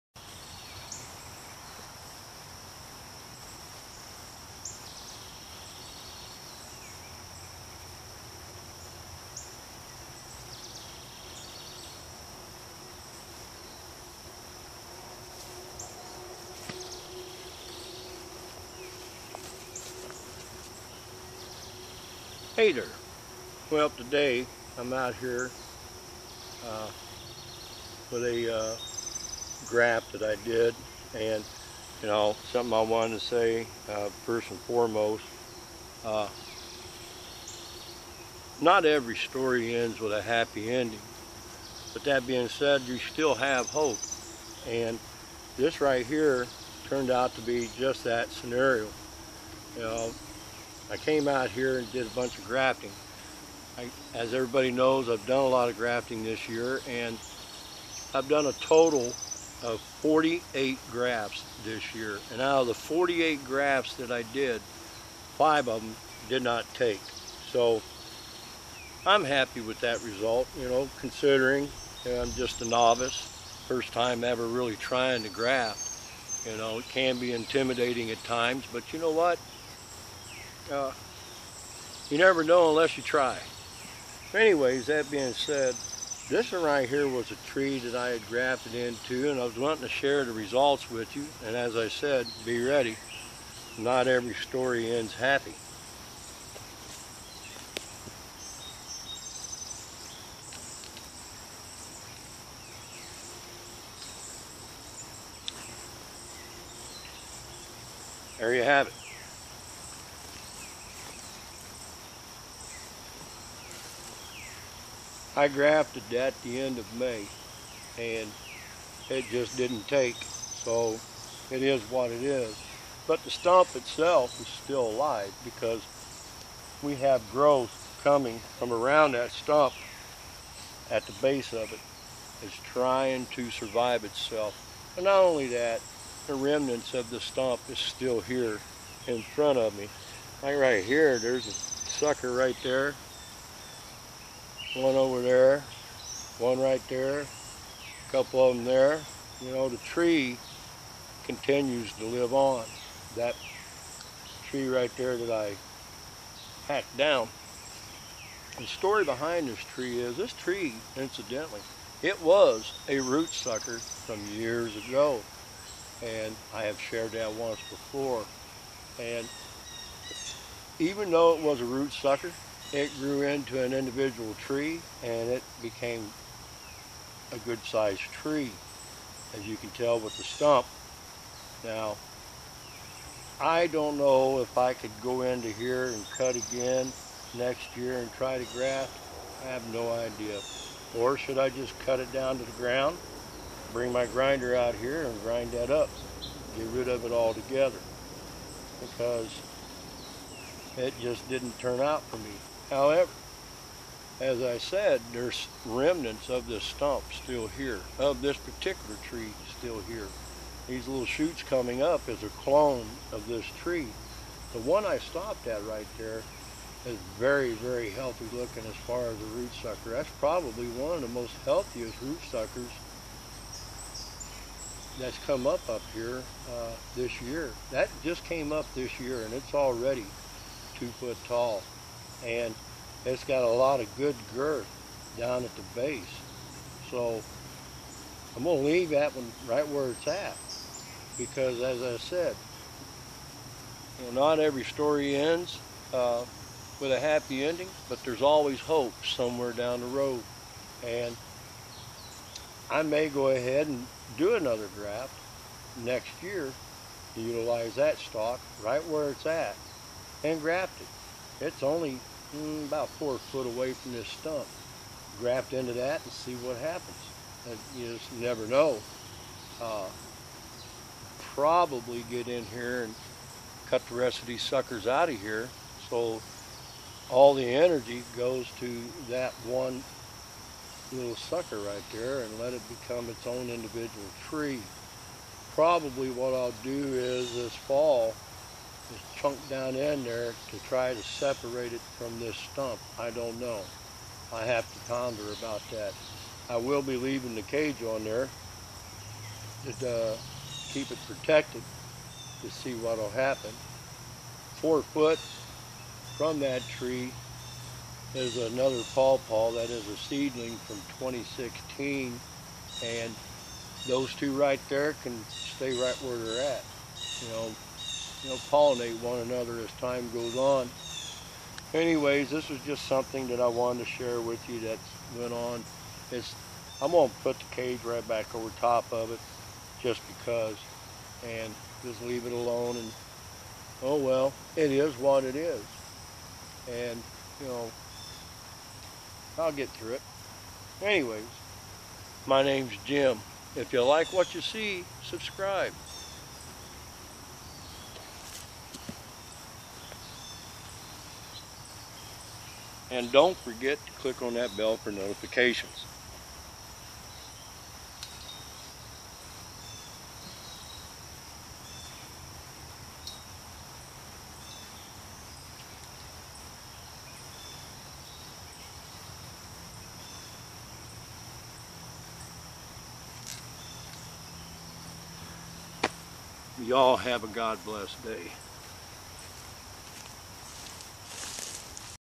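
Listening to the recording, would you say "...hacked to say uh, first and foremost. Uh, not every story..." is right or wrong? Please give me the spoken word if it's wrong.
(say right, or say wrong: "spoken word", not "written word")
wrong: "wanted", not "hacked".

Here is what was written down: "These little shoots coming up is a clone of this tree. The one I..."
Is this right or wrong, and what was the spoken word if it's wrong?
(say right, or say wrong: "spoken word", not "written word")
right.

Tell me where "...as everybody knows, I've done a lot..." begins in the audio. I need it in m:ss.
0:54.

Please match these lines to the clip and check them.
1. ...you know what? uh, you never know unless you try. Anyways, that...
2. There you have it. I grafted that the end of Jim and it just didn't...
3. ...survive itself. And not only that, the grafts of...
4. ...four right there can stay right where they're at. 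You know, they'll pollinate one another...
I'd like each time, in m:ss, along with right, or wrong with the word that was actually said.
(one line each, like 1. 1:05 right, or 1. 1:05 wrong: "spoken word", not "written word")
1. 1:18 right
2. 1:48 wrong: "May", not "Jim"
3. 2:13 wrong: "remnants", not "grafts"
4. 5:14 wrong: "two", not "four".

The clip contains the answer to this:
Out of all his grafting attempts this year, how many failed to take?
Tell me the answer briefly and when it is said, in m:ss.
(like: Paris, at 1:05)
5, at 1:05.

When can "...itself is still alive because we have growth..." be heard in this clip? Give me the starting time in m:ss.
2:03.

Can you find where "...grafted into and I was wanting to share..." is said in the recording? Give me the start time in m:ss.
1:28.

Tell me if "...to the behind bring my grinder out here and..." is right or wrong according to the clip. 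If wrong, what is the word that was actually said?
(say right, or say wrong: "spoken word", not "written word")
wrong: "ground", not "behind".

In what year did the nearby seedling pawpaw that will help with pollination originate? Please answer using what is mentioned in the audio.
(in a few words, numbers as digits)
2016.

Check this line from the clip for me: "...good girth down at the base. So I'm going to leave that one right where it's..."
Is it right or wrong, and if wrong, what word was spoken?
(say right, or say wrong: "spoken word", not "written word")
right.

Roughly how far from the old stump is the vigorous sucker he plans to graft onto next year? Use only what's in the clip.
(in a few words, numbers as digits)
4 feet.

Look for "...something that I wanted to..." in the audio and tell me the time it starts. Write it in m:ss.
5:22.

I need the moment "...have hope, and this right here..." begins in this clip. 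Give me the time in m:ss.
0:43.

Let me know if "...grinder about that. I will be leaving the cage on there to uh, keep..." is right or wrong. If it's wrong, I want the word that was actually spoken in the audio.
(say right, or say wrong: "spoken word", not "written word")
wrong: "ponder", not "grinder".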